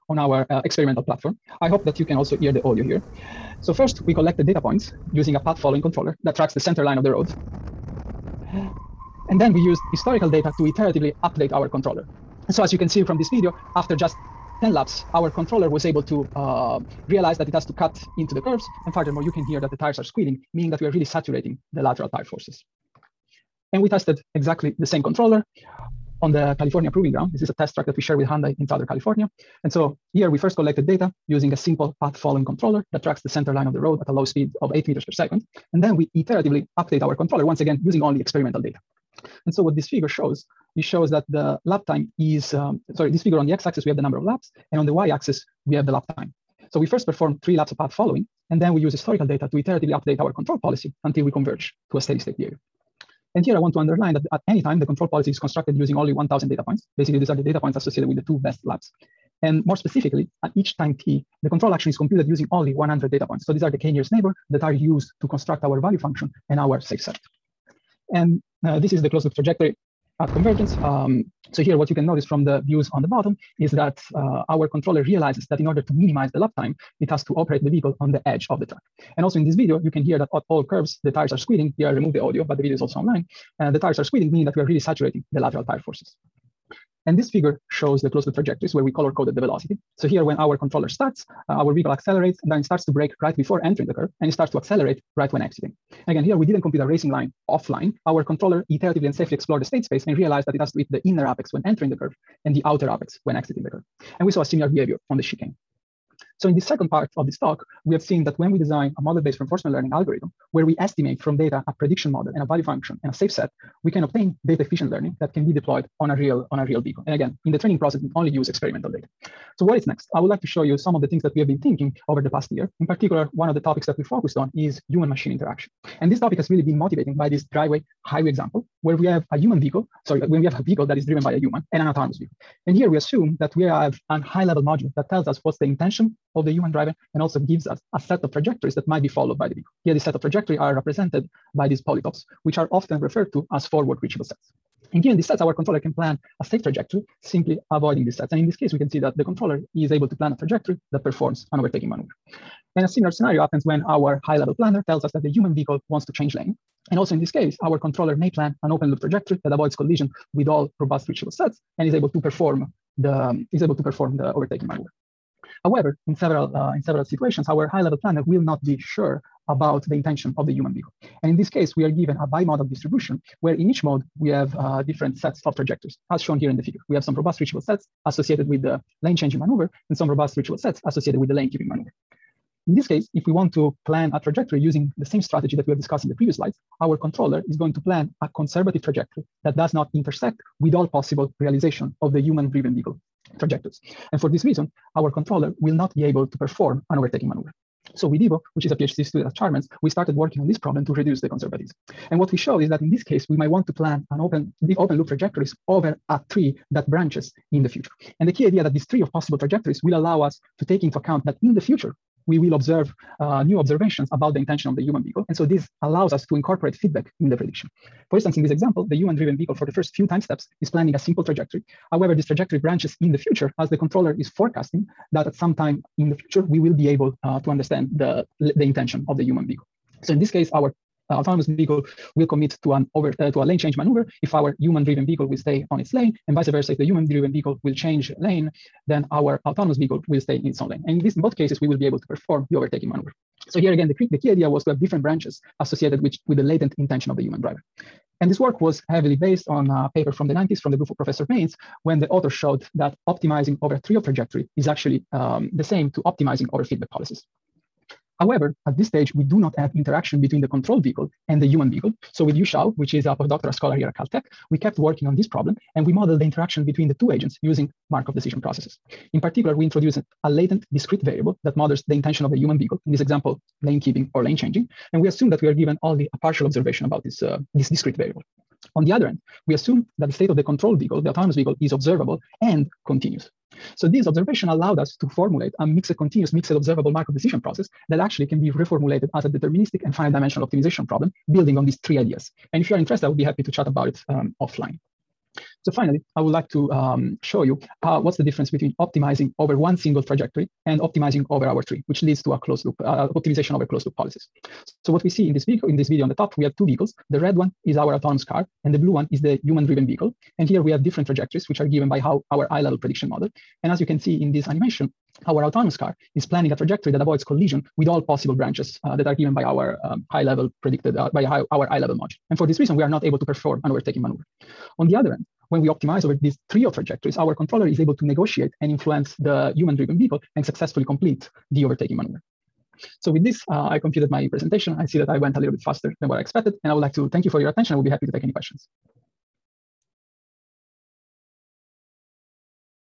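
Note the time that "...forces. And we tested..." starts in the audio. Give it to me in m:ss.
0:22.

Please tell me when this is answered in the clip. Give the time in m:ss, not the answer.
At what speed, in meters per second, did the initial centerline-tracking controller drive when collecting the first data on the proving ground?
0:34.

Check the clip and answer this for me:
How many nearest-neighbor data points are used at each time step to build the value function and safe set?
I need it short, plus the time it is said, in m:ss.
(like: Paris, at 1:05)
100, at 1:02.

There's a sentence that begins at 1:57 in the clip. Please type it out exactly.
And again, in the training process, we only use experimental data.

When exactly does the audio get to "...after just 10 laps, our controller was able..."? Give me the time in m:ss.
0:13.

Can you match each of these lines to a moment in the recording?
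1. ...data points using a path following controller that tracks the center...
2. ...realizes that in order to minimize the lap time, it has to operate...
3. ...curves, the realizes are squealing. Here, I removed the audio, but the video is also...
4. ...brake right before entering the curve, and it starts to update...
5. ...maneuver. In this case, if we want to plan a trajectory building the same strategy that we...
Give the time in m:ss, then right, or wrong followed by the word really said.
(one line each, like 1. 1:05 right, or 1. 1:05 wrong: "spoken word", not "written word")
1. 0:04 right
2. 1:15 right
3. 1:20 wrong: "tires", not "realizes"
4. 1:32 wrong: "accelerate", not "update"
5. 3:01 wrong: "using", not "building".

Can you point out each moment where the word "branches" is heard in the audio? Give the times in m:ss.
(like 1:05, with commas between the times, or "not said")
3:26, 3:42, 4:05, 5:18.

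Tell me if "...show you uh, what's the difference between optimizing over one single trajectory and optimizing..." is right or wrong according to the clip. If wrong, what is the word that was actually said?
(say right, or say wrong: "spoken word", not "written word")
right.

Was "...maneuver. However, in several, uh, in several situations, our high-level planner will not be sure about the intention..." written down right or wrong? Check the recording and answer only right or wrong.
right.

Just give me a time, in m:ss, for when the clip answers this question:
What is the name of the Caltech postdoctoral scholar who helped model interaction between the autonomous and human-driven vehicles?
4:22.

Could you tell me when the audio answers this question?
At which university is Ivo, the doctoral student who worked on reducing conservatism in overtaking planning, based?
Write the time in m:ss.
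3:19.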